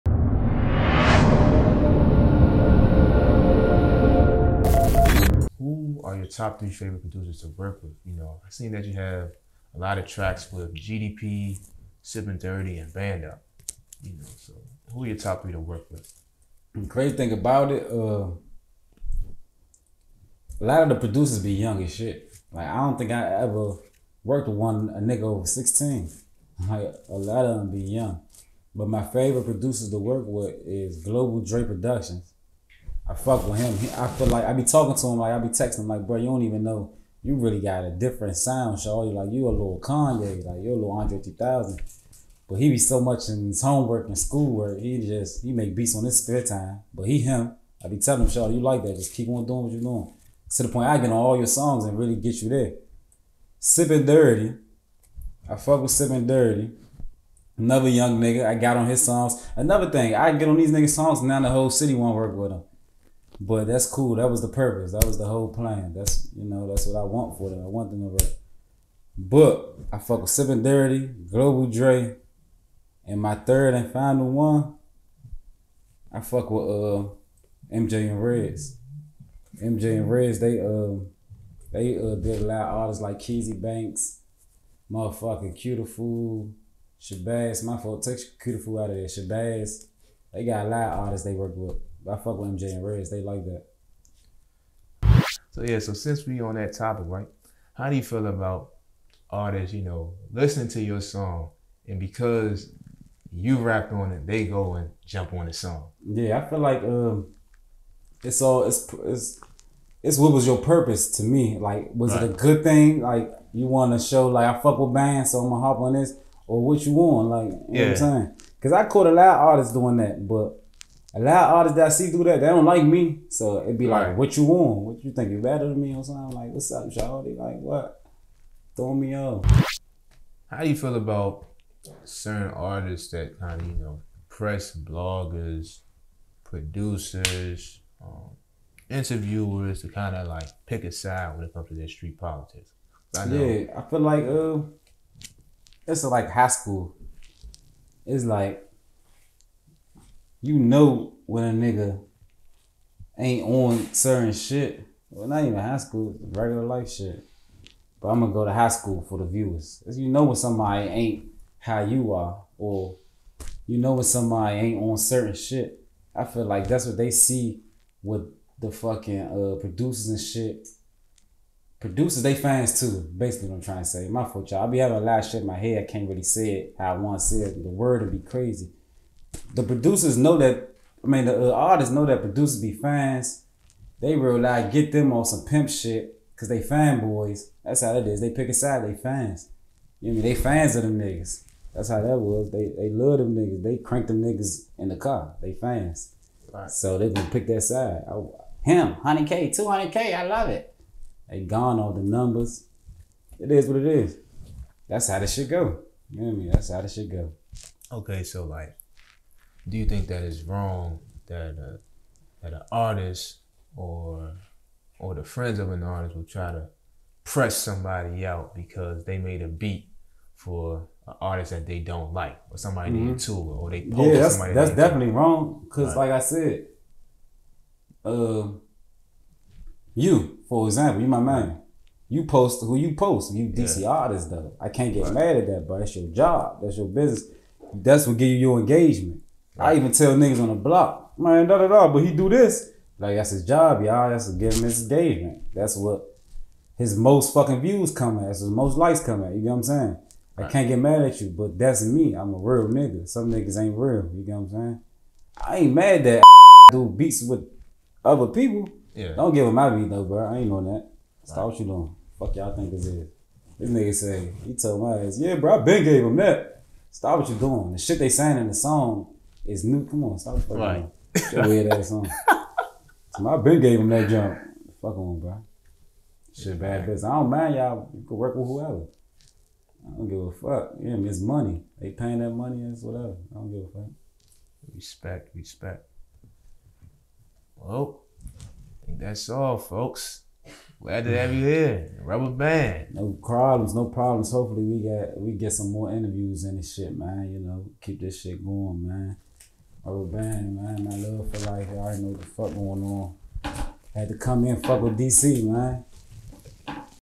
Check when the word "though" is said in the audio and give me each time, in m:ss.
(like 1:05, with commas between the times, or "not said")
3:54, 4:19.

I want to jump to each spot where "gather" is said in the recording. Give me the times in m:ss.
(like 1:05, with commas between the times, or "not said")
not said.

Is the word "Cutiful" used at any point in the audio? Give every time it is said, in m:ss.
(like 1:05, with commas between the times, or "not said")
1:25.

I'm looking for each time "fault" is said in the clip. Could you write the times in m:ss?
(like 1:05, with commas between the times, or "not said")
1:27, 2:54.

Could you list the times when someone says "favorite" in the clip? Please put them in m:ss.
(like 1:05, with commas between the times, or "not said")
0:06, 0:29.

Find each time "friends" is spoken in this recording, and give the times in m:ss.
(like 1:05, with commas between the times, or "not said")
3:35.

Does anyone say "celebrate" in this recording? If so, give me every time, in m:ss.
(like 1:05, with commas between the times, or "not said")
not said.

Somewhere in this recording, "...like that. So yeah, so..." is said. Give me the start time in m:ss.
1:33.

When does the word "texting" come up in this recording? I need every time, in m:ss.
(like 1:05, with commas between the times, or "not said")
0:35.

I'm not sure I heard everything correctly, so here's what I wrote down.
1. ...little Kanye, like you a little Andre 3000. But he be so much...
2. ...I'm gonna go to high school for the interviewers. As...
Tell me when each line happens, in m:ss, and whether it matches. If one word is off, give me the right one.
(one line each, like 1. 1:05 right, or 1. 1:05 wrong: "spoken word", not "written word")
1. 0:39 right
2. 2:38 wrong: "viewers", not "interviewers".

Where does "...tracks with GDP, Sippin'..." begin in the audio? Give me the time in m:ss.
0:10.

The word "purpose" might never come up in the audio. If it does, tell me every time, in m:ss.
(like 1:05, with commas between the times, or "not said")
1:04, 1:50.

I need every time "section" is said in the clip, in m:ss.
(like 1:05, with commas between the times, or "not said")
not said.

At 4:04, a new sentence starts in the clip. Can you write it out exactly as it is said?
That's to give him his engagement.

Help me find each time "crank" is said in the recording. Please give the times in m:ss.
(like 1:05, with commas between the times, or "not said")
3:13.